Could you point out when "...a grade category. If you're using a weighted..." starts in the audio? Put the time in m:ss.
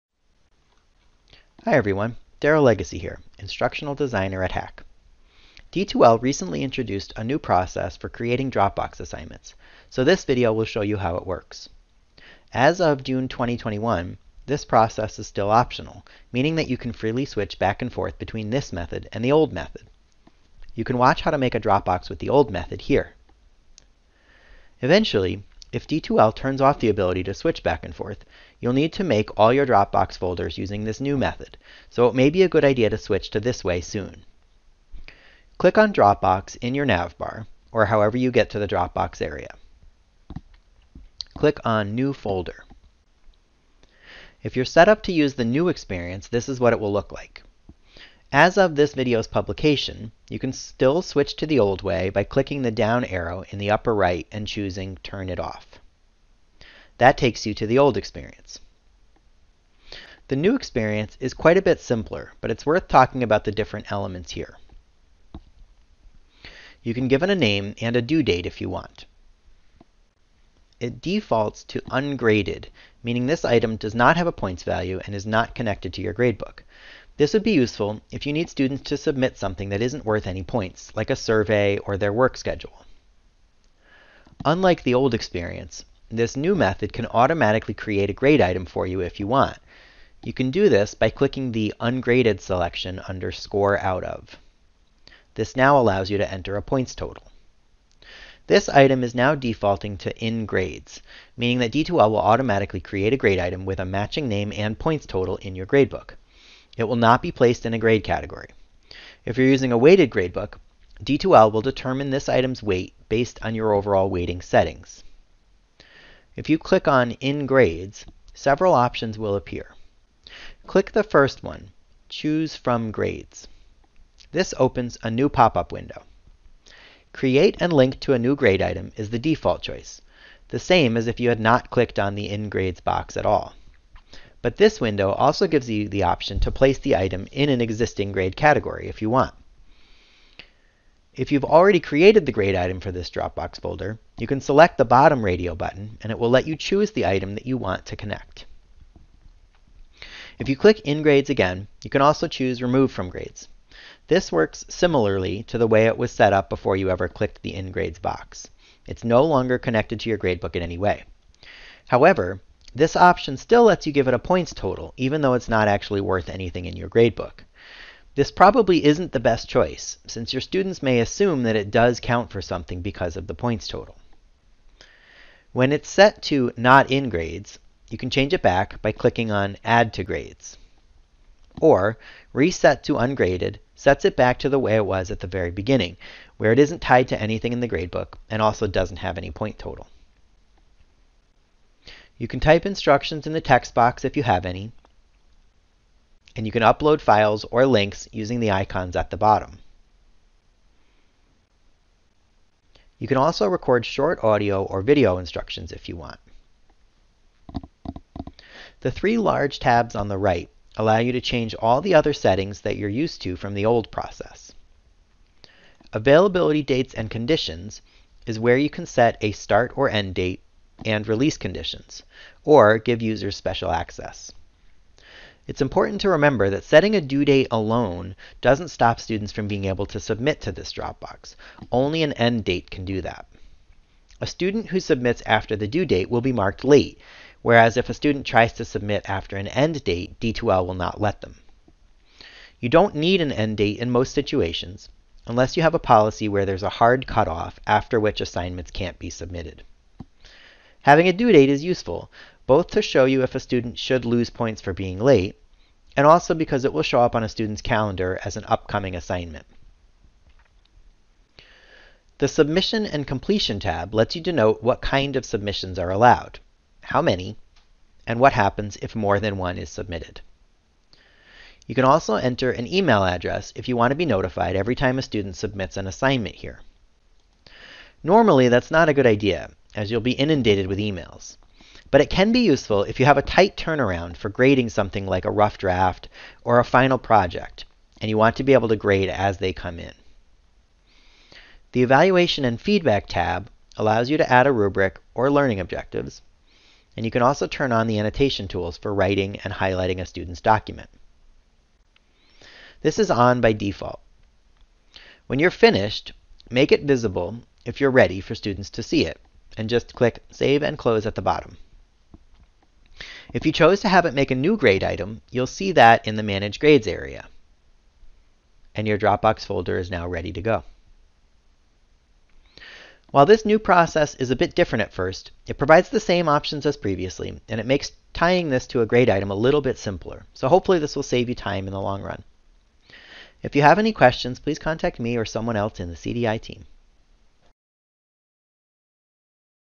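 1:47.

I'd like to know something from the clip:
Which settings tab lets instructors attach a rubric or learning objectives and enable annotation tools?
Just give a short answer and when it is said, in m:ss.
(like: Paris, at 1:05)
Evaluation and Feedback, at 4:51.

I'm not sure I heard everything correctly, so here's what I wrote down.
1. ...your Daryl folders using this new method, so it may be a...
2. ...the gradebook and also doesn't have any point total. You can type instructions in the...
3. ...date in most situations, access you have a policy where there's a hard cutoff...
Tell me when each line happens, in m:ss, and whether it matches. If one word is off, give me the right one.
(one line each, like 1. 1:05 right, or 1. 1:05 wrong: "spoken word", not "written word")
1. 0:29 wrong: "Dropbox", not "Daryl"
2. 3:07 right
3. 4:03 wrong: "unless", not "access".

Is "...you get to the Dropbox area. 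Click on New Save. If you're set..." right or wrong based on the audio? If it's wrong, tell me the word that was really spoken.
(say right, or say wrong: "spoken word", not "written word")
wrong: "Folder", not "Save".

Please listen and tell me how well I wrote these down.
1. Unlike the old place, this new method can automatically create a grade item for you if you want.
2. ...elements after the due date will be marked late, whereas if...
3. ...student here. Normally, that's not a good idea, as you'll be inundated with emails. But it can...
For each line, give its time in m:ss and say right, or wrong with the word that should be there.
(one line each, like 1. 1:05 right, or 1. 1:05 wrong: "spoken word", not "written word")
1. 1:24 wrong: "experience", not "place"
2. 3:54 wrong: "submits", not "elements"
3. 4:35 wrong: "assignment", not "student".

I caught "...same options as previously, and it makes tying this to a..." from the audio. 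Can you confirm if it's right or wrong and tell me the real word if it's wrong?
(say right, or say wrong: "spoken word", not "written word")
right.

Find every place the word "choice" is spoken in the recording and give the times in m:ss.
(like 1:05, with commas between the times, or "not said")
2:09, 2:49.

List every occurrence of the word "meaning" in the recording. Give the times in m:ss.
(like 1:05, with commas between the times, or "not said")
0:16, 1:13, 1:41.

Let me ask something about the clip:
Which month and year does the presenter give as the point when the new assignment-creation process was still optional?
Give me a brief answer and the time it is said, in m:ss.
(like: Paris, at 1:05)
June 2021, at 0:13.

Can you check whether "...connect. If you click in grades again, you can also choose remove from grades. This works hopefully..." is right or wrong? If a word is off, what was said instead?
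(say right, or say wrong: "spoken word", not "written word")
wrong: "similarly", not "hopefully".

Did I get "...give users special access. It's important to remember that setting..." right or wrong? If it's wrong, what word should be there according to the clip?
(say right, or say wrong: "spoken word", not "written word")
right.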